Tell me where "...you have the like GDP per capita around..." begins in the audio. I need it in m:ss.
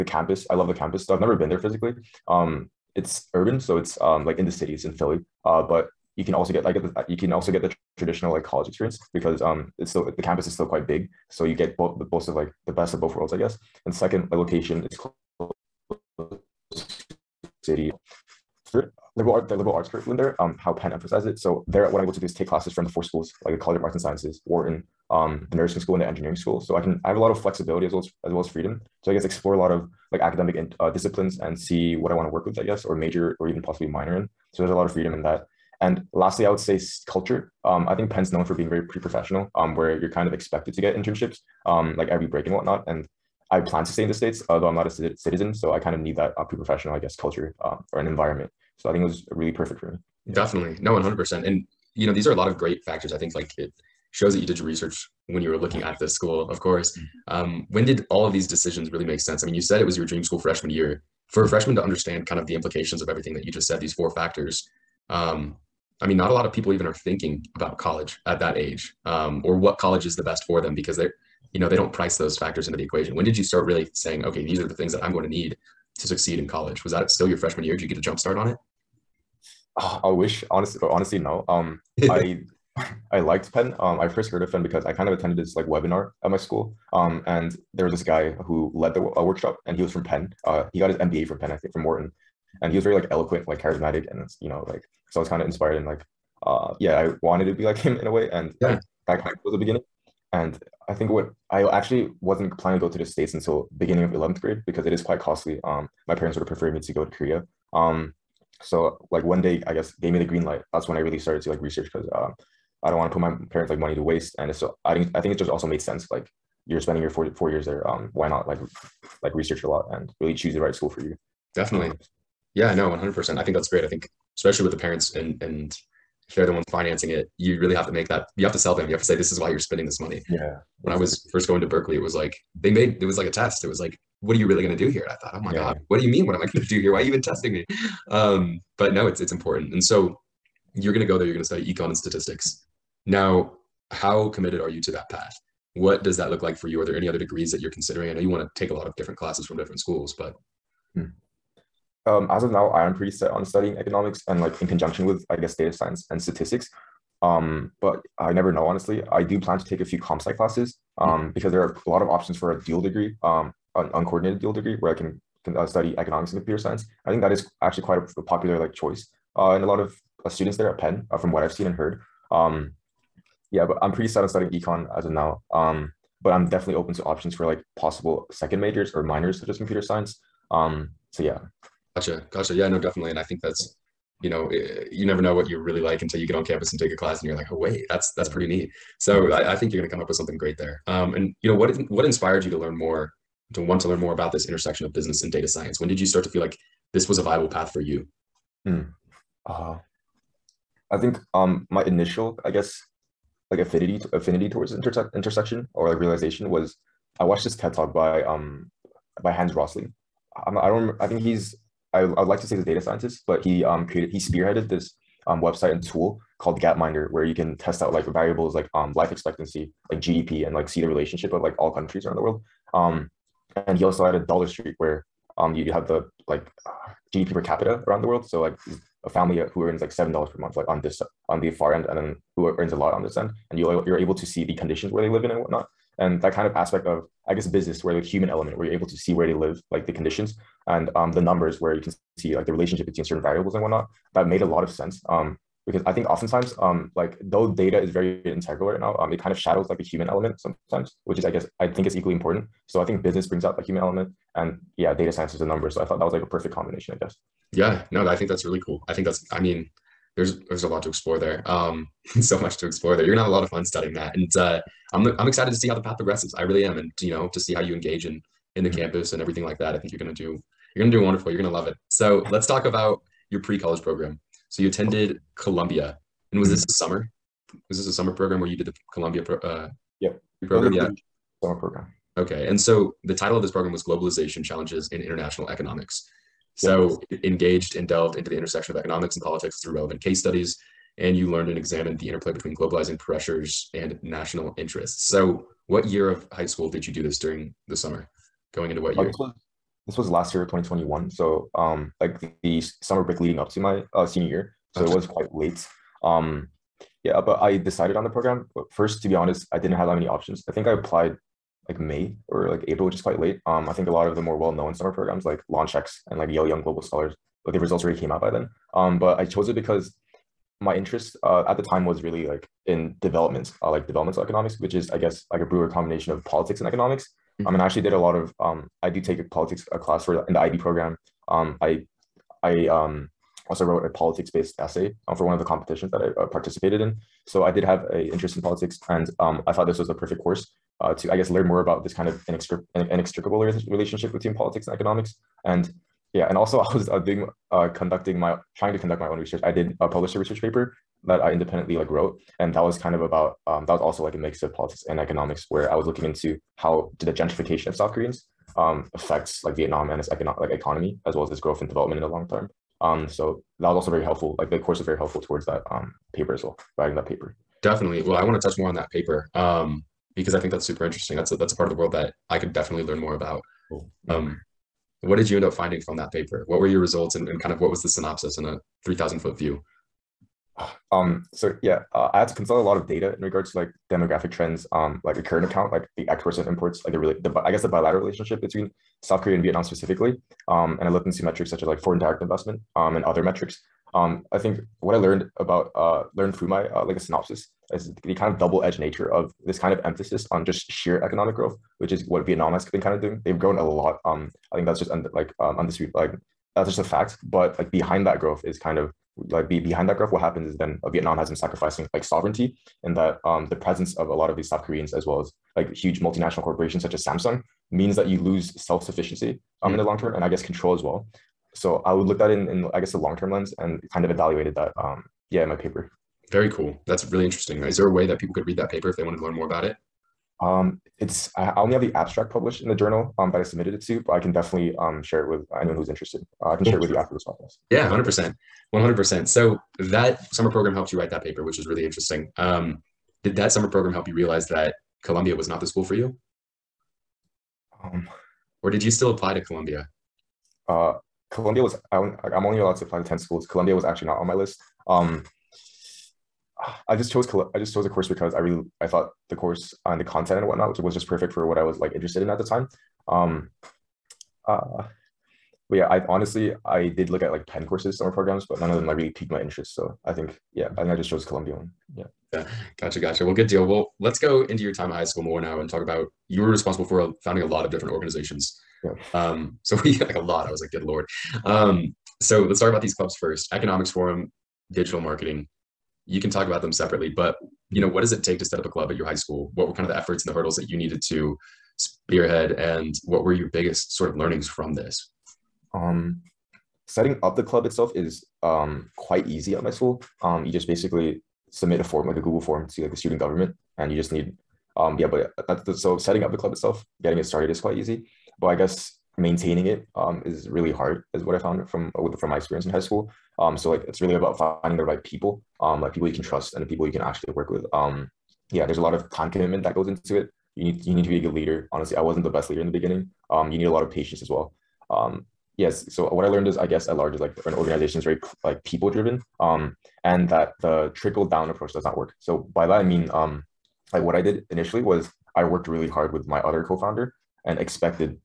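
3:45.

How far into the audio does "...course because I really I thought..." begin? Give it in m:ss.
7:37.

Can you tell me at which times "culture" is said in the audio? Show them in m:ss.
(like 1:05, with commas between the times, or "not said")
0:37, 0:47.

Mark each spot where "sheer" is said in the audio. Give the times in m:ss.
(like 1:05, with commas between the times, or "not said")
6:40.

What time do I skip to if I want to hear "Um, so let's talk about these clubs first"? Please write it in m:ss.
8:01.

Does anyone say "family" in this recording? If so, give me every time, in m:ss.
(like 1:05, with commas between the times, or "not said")
3:49.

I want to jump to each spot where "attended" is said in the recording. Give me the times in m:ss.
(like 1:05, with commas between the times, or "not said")
1:25, 4:34.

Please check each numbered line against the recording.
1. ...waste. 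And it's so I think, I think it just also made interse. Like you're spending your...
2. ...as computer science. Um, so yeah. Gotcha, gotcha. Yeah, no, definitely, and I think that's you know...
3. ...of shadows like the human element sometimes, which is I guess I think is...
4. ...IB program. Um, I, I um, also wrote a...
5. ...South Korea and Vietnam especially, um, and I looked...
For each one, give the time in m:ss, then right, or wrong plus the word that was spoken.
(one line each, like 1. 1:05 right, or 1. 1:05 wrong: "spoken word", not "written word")
1. 1:54 wrong: "sense", not "interse"
2. 2:59 right
3. 4:09 right
4. 5:30 right
5. 6:29 wrong: "specifically", not "especially".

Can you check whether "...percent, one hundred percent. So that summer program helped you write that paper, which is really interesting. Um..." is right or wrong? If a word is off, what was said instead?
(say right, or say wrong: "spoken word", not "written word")
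right.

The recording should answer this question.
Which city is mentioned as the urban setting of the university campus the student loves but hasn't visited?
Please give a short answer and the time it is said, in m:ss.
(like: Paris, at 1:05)
Philly, at 0:04.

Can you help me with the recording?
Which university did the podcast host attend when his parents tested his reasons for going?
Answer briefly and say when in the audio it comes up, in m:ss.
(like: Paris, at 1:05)
Berkeley, at 2:11.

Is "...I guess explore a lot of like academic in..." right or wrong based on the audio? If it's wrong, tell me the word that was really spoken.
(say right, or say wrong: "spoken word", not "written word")
right.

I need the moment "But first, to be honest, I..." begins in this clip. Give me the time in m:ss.
5:08.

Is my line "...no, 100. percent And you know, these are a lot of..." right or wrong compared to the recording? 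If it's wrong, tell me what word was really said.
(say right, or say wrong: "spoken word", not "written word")
right.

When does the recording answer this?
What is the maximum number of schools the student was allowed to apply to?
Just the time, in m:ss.
7:33.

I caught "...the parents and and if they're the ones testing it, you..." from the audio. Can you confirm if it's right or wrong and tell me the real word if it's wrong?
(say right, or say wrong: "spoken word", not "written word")
wrong: "financing", not "testing".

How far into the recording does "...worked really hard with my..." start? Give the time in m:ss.
8:55.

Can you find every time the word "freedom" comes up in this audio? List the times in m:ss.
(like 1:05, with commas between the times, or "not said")
0:28, 0:34.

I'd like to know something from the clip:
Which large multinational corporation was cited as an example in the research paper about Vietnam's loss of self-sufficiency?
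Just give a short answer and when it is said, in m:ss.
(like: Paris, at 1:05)
Samsung, at 6:57.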